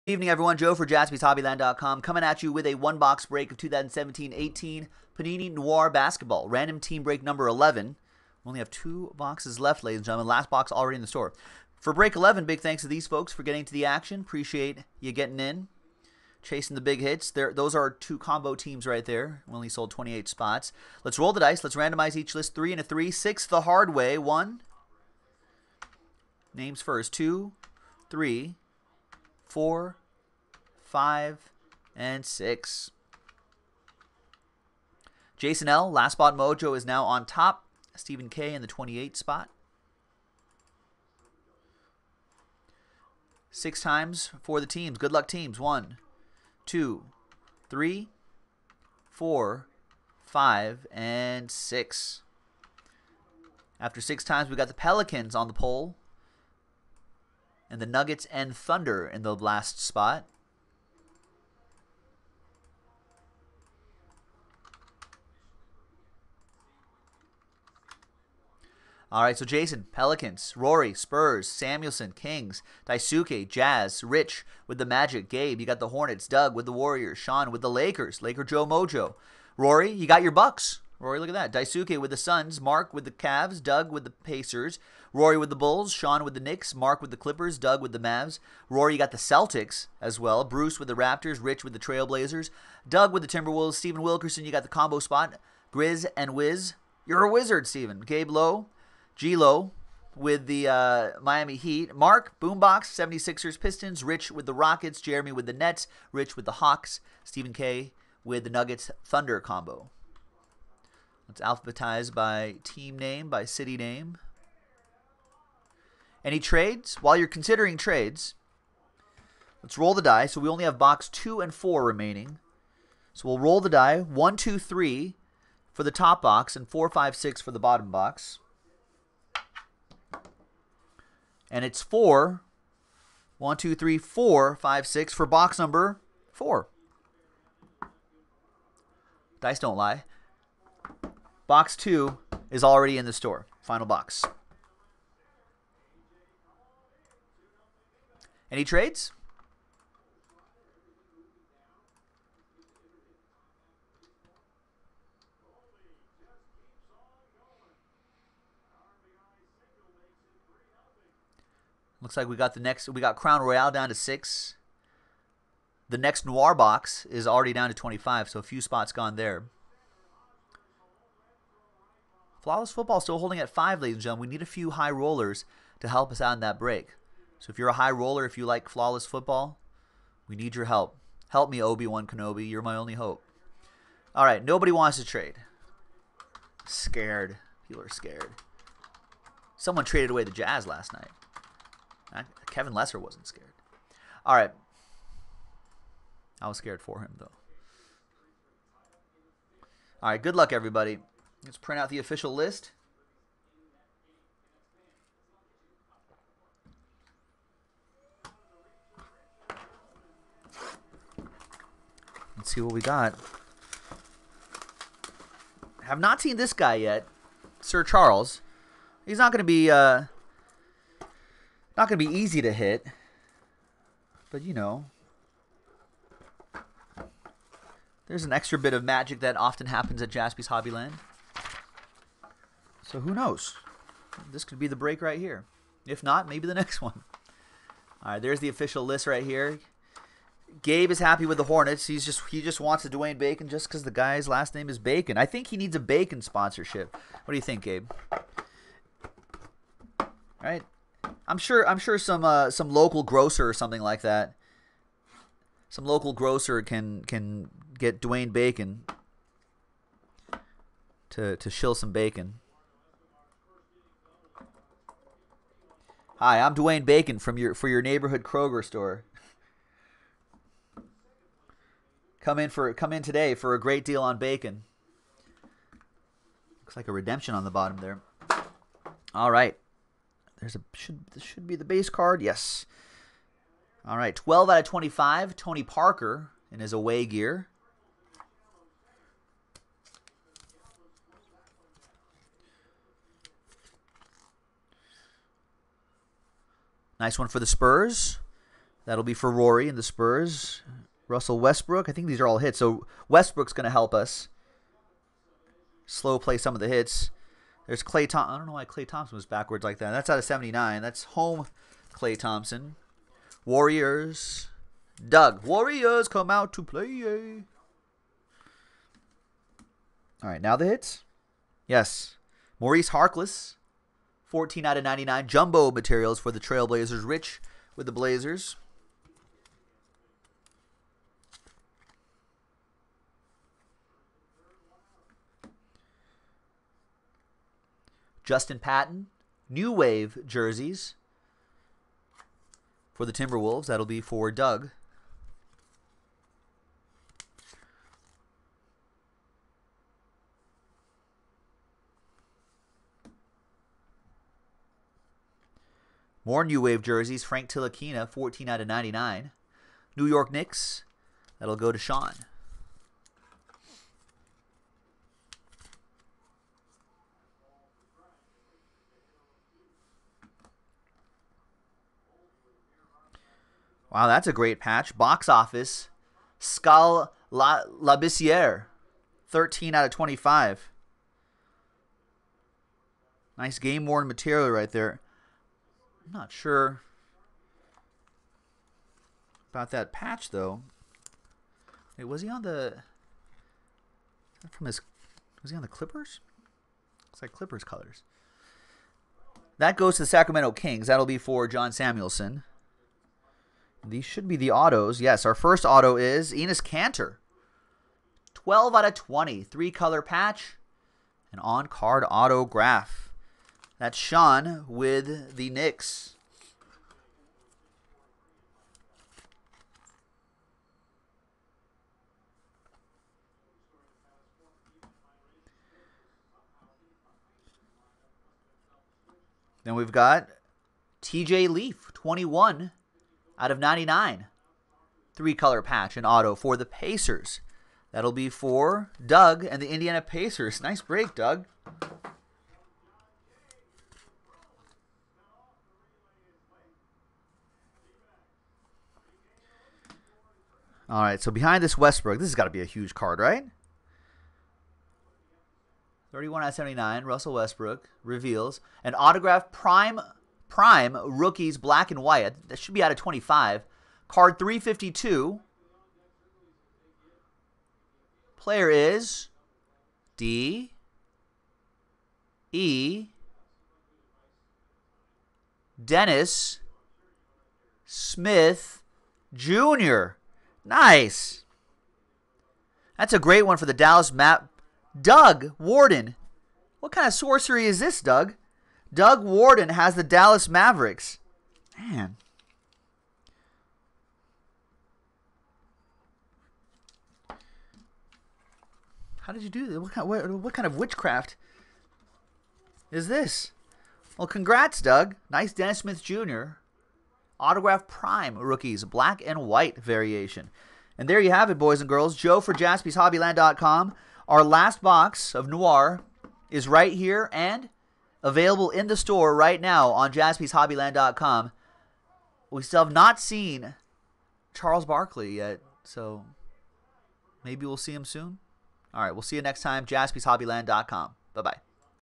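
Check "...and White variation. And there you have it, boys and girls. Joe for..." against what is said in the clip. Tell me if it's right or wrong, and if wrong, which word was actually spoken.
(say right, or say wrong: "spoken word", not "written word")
right.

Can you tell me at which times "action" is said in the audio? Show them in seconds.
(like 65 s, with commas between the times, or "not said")
13 s.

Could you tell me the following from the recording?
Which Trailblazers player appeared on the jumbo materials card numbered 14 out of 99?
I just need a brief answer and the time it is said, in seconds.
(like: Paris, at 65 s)
Maurice Harkless, at 322 s.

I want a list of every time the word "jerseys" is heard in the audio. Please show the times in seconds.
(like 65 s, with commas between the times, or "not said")
340 s, 356 s.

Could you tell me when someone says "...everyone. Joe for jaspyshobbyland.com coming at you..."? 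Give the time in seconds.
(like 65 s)
0 s.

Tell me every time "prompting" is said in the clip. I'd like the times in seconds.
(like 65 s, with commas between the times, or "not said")
not said.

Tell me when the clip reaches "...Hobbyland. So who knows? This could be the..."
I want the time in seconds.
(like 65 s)
230 s.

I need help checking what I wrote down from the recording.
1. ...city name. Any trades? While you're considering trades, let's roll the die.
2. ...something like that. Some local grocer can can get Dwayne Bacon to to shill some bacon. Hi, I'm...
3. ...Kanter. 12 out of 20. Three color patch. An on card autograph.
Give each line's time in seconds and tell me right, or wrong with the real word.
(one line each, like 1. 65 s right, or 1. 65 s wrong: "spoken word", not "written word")
1. 113 s right
2. 253 s right
3. 406 s right.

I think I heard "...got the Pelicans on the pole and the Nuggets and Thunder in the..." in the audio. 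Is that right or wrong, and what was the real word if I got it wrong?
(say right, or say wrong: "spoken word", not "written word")
right.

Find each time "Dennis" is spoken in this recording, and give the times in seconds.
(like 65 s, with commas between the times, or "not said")
475 s, 505 s.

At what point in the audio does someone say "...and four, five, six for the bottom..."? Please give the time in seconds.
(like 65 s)
126 s.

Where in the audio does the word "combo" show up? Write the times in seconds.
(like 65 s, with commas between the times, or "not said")
18 s, 94 s, 109 s.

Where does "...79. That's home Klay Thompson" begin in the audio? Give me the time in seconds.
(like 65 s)
310 s.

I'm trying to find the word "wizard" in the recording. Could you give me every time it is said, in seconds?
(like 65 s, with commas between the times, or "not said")
97 s.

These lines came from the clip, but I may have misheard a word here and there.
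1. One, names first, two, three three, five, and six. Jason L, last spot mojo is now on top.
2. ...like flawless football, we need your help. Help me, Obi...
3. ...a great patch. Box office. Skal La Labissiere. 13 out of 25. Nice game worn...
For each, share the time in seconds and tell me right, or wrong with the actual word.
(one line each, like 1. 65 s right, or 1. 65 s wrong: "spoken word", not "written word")
1. 24 s wrong: "four", not "three"
2. 178 s right
3. 374 s right.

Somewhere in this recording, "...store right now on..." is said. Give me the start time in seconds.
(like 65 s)
518 s.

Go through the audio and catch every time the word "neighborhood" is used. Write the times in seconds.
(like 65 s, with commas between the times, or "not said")
267 s.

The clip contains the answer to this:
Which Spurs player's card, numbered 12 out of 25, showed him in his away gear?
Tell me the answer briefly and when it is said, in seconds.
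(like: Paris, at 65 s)
Tony Parker, at 285 s.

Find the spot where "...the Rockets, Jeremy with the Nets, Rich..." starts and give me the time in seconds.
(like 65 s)
104 s.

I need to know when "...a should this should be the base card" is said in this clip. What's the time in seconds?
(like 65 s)
280 s.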